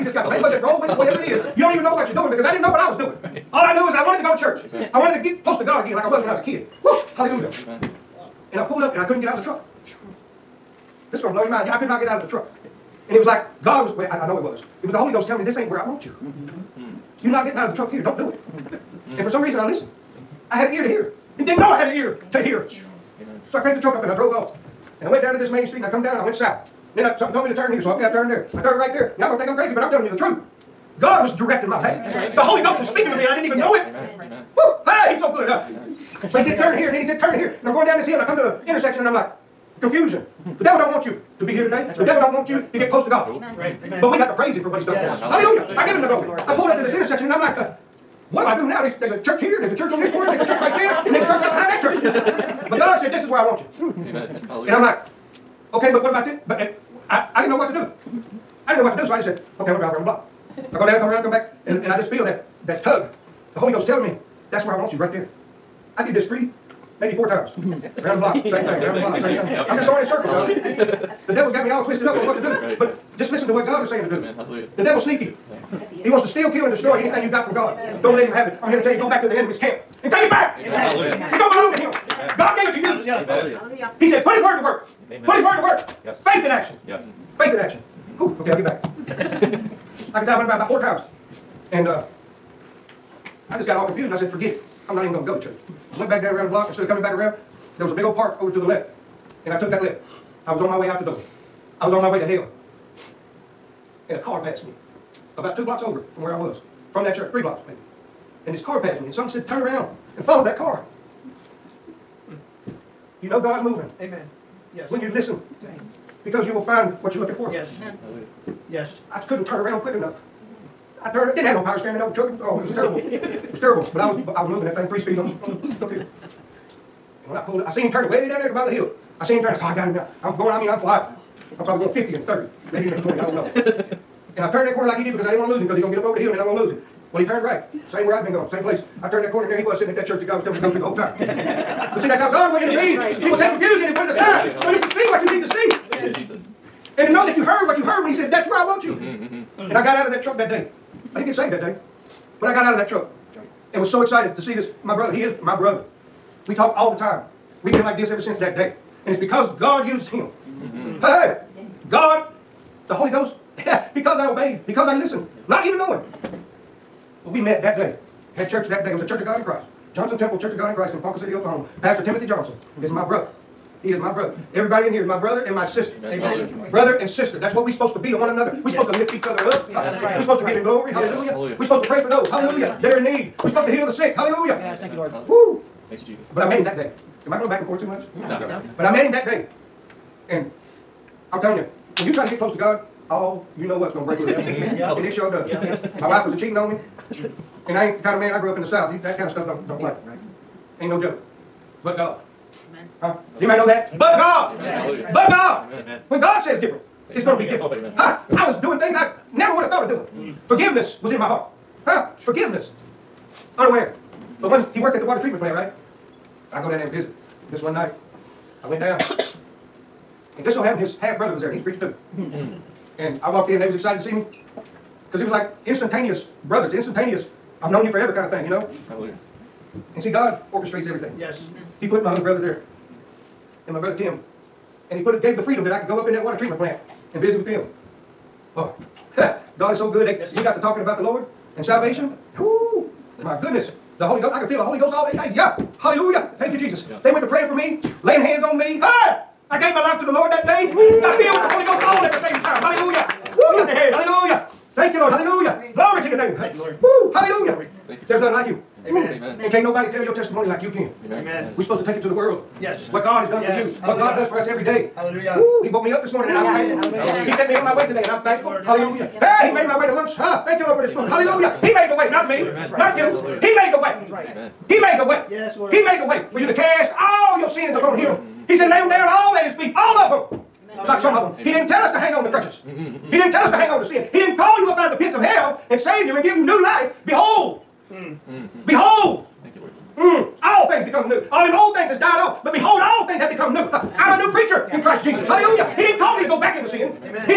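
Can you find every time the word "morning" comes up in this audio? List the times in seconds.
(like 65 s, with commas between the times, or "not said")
266 s.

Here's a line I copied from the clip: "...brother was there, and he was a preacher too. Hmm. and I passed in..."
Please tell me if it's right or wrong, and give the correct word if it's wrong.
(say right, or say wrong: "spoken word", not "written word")
wrong: "walked", not "passed".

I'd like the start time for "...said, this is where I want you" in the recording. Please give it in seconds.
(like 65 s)
52 s.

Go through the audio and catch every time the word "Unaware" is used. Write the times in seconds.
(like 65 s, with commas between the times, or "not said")
213 s.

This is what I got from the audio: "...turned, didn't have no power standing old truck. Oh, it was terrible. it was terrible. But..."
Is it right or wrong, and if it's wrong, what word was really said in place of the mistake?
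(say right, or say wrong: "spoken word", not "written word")
right.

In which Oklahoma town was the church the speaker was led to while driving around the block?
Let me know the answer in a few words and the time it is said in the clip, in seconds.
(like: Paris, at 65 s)
Ponca City, at 171 s.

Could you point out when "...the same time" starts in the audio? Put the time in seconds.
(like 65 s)
252 s.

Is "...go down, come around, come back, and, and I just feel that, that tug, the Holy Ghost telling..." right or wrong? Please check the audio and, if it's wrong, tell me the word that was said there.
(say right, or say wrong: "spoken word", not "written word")
right.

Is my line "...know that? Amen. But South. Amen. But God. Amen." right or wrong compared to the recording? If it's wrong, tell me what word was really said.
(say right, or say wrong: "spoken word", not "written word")
wrong: "God", not "South".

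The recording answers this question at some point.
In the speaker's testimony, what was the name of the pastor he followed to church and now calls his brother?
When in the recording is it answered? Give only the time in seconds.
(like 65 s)
171 s.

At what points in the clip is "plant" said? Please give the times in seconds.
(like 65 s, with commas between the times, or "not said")
215 s, 236 s.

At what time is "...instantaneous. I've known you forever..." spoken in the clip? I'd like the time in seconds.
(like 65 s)
226 s.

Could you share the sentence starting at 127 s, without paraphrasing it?
When I pulled up, I seen him turning way down there at the bottom of the hill.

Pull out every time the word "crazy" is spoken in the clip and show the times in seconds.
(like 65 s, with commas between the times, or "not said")
29 s.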